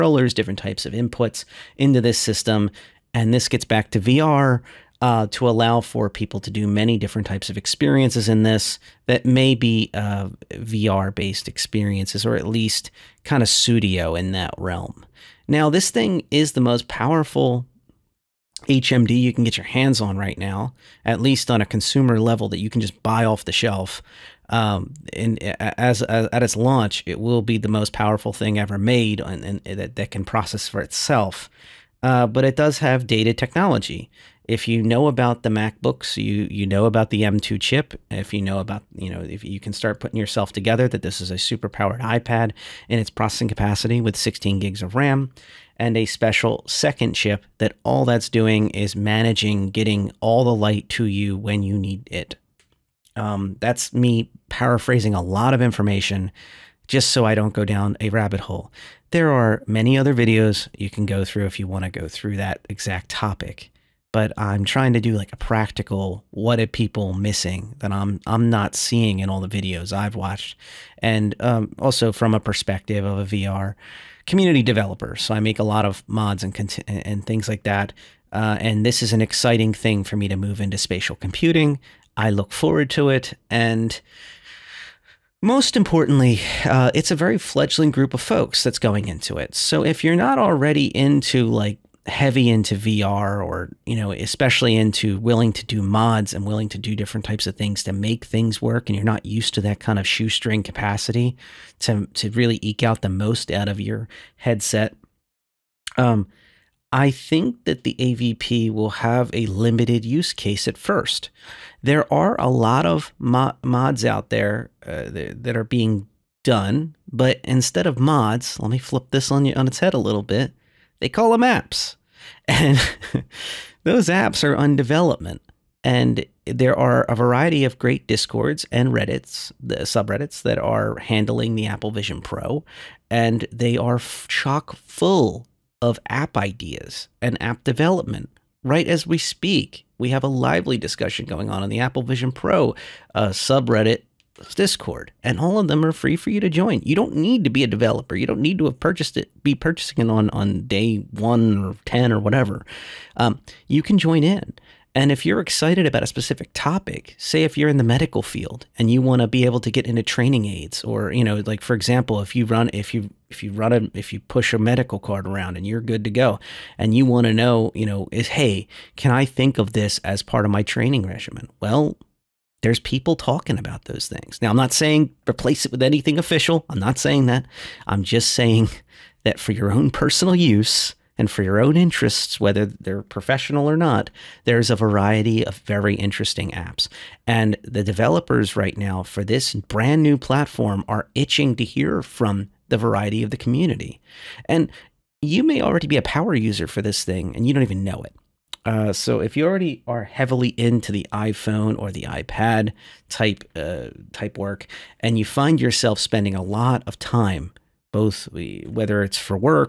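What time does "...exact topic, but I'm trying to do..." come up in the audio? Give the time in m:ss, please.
1:02.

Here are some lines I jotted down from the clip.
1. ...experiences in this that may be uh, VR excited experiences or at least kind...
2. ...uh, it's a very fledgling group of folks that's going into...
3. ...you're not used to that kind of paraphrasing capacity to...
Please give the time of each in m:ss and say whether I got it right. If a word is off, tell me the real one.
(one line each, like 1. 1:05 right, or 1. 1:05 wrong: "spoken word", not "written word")
1. 0:07 wrong: "based", not "excited"
2. 1:26 right
3. 1:38 wrong: "shoestring", not "paraphrasing".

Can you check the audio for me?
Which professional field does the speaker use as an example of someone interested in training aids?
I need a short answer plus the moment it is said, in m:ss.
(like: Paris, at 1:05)
medical field, at 2:37.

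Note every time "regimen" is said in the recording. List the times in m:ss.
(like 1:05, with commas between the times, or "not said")
2:51.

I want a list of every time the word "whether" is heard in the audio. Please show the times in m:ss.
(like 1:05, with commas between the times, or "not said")
3:02, 3:28.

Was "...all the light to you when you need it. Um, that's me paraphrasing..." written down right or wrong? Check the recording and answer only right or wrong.
right.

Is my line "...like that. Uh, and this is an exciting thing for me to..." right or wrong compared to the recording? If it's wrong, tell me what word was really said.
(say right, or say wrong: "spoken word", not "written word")
right.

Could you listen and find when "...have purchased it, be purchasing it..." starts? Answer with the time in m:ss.
2:28.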